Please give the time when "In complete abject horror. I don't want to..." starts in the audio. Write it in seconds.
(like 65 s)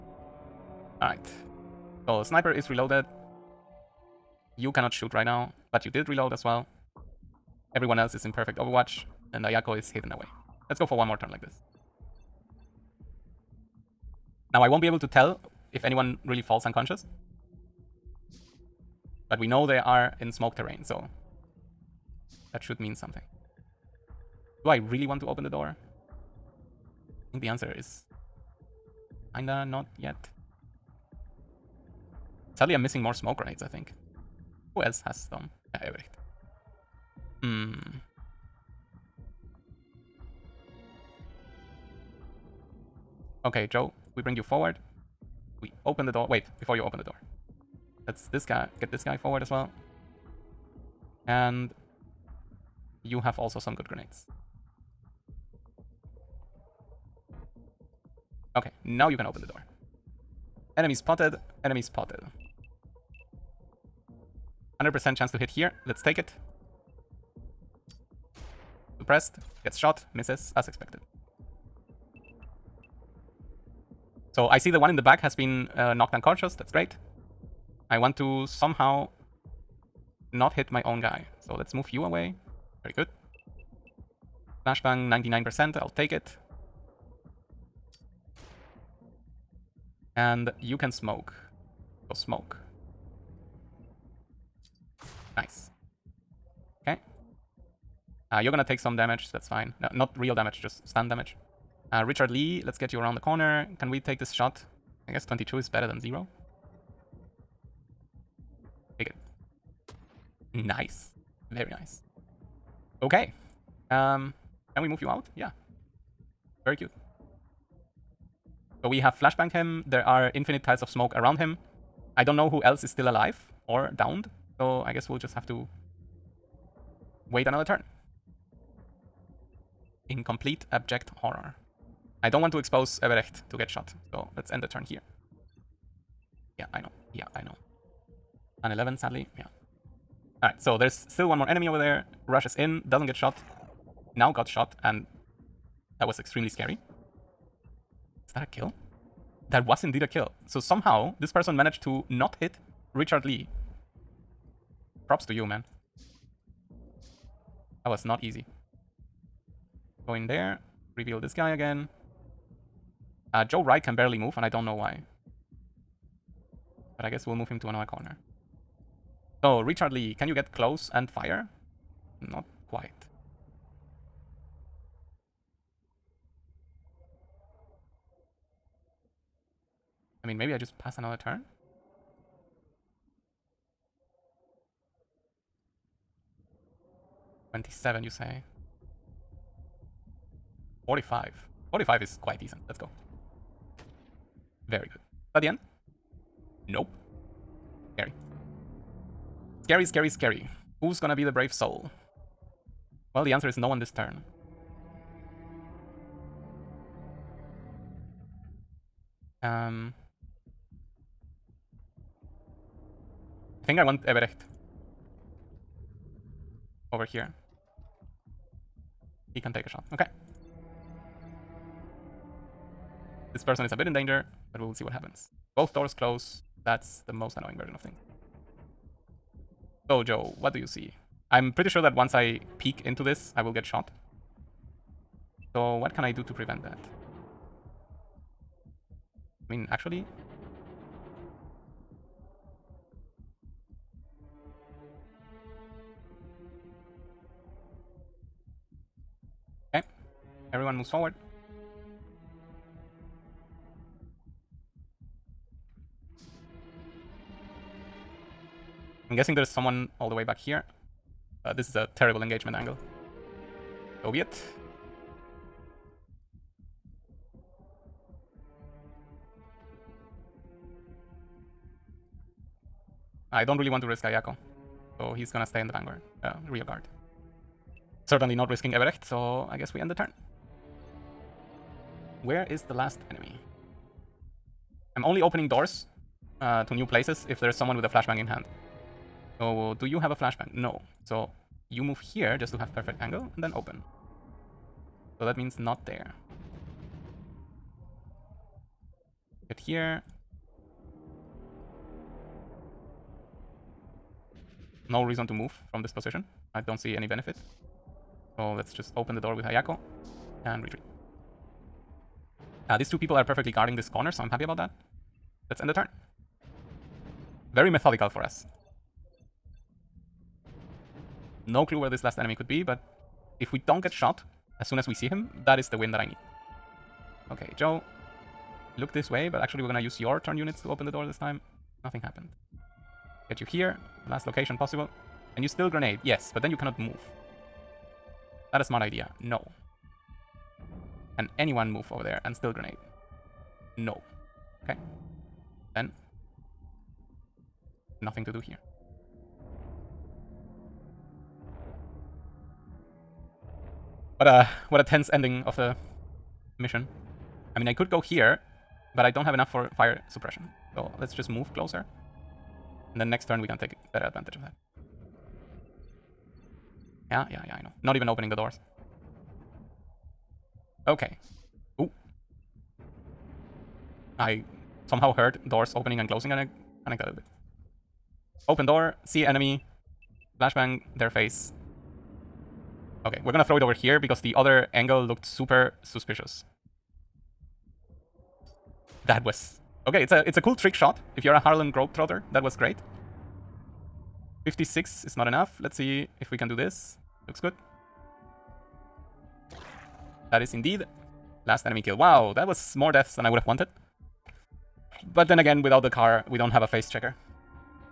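130 s.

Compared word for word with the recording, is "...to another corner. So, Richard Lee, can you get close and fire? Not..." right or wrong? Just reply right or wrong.
right.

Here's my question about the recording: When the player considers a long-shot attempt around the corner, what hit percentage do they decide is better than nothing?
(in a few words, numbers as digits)
22.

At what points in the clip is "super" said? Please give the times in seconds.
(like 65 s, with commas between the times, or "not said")
385 s.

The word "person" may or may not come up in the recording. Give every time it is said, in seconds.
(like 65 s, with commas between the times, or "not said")
151 s, 223 s.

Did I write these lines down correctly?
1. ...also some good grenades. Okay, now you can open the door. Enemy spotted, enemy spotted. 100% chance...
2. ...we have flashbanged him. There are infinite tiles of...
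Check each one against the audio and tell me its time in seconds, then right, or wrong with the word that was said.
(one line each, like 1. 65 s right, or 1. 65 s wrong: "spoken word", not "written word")
1. 53 s right
2. 118 s right.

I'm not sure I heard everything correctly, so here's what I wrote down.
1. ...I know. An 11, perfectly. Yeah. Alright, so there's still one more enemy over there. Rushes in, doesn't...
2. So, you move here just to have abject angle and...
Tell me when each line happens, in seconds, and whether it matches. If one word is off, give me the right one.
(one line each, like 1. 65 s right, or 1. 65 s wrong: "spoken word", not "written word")
1. 137 s wrong: "sadly", not "perfectly"
2. 291 s wrong: "perfect", not "abject".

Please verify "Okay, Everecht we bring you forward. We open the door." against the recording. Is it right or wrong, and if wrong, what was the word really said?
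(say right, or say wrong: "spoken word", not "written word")
wrong: "Joe", not "Everecht".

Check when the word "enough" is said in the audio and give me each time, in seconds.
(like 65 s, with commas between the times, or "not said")
359 s, 395 s.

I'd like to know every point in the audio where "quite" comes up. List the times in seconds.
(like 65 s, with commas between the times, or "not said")
172 s, 192 s.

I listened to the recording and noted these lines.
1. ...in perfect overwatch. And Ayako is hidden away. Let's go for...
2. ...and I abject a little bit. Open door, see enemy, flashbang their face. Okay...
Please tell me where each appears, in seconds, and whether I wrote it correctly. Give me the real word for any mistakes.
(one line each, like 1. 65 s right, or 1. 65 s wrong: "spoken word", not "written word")
1. 8 s right
2. 376 s wrong: "connect", not "abject".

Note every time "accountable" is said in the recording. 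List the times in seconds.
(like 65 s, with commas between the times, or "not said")
not said.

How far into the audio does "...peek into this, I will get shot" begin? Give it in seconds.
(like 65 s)
232 s.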